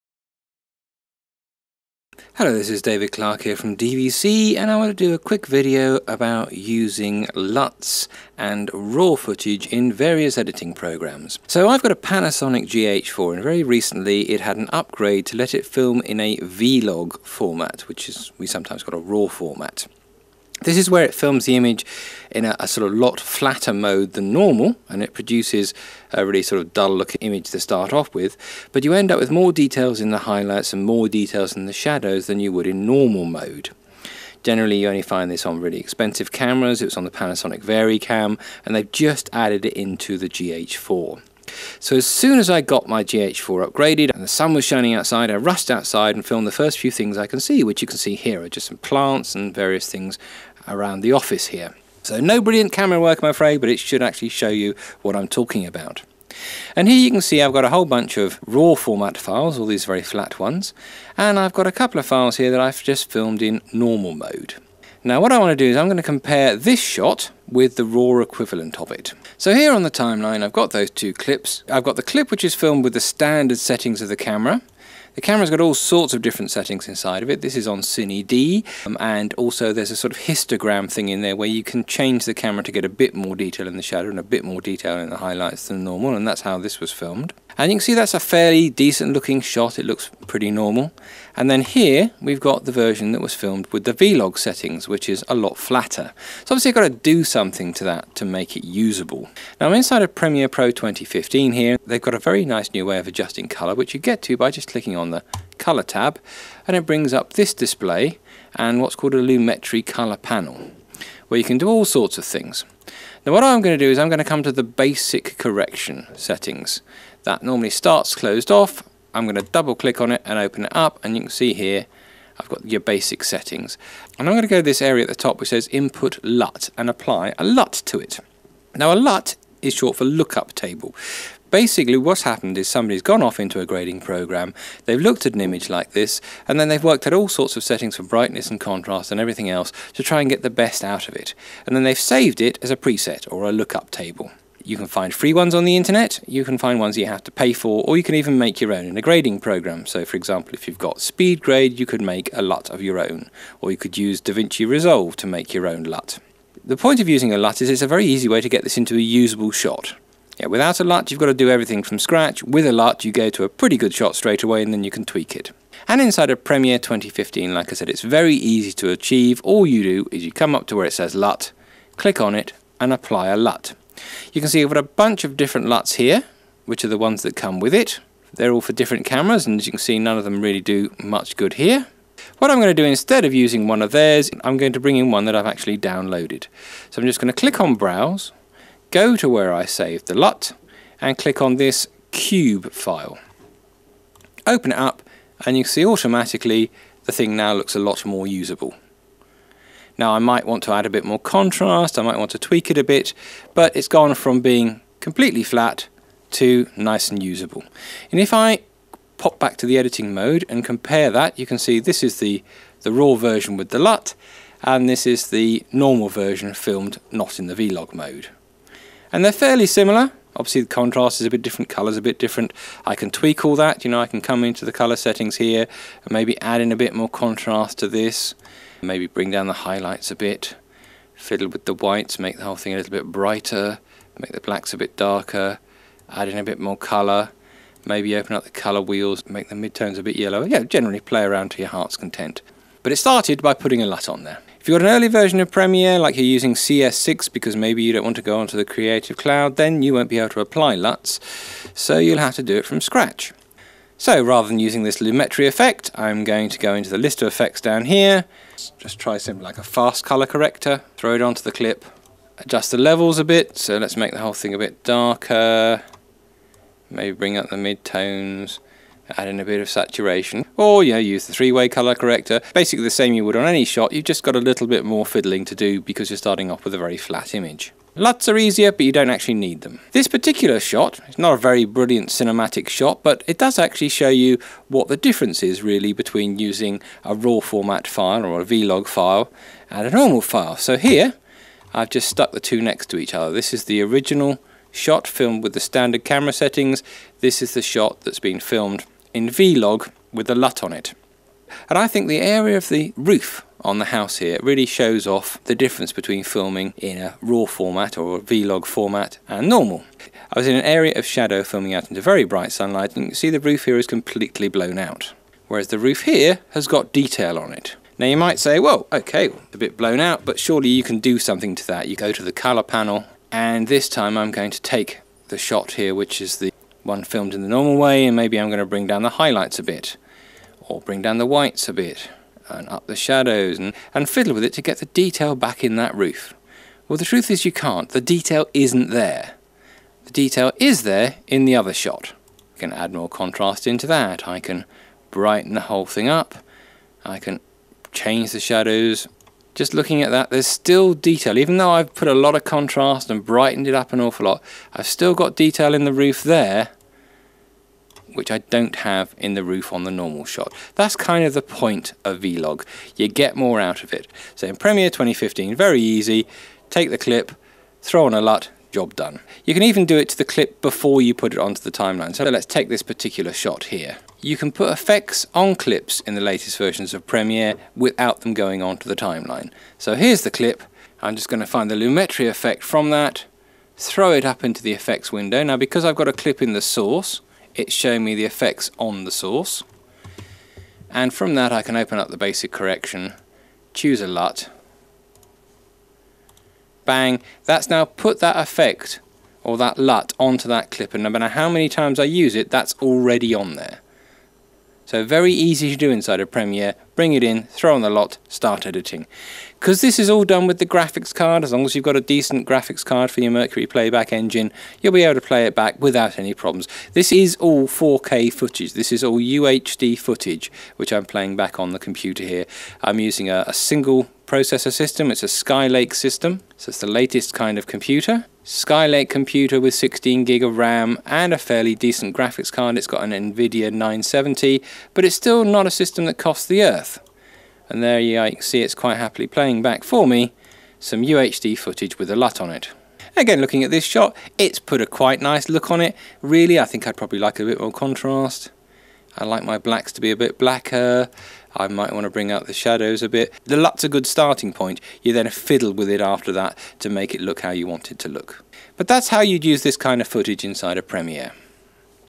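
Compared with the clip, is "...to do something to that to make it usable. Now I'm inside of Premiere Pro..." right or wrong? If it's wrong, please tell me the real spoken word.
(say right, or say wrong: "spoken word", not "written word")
right.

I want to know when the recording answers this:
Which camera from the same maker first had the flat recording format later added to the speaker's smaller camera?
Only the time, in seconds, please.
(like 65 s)
37 s.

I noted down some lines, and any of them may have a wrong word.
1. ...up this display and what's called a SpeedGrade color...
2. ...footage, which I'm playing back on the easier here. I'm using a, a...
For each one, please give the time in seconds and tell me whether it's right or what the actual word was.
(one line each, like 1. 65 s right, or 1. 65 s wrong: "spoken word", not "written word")
1. 107 s wrong: "Lumetri", not "SpeedGrade"
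2. 419 s wrong: "computer", not "easier".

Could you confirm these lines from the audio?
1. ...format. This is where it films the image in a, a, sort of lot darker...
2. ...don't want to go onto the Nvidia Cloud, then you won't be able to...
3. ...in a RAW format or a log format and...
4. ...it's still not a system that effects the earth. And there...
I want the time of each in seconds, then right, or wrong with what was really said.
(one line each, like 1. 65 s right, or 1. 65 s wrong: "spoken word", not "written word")
1. 19 s wrong: "flatter", not "darker"
2. 247 s wrong: "Creative", not "Nvidia"
3. 306 s right
4. 435 s wrong: "costs", not "effects".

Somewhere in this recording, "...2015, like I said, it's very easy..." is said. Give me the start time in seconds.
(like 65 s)
166 s.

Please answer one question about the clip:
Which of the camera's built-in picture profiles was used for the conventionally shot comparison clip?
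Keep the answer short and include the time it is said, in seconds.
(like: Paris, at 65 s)
Cine D, at 77 s.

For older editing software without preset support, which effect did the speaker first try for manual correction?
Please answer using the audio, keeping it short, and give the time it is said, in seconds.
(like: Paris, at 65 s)
fast color corrector, at 259 s.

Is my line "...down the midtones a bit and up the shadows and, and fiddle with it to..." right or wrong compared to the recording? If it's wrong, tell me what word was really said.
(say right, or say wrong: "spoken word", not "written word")
wrong: "whites", not "midtones".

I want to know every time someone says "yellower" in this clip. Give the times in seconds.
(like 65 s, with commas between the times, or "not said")
240 s.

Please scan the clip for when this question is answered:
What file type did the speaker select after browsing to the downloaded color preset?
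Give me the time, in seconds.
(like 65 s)
192 s.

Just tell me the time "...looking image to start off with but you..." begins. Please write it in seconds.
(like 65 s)
26 s.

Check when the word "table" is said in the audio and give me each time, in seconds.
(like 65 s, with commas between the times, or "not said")
130 s, 143 s.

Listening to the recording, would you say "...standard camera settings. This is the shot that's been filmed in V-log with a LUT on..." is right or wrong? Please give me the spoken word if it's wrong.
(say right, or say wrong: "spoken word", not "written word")
right.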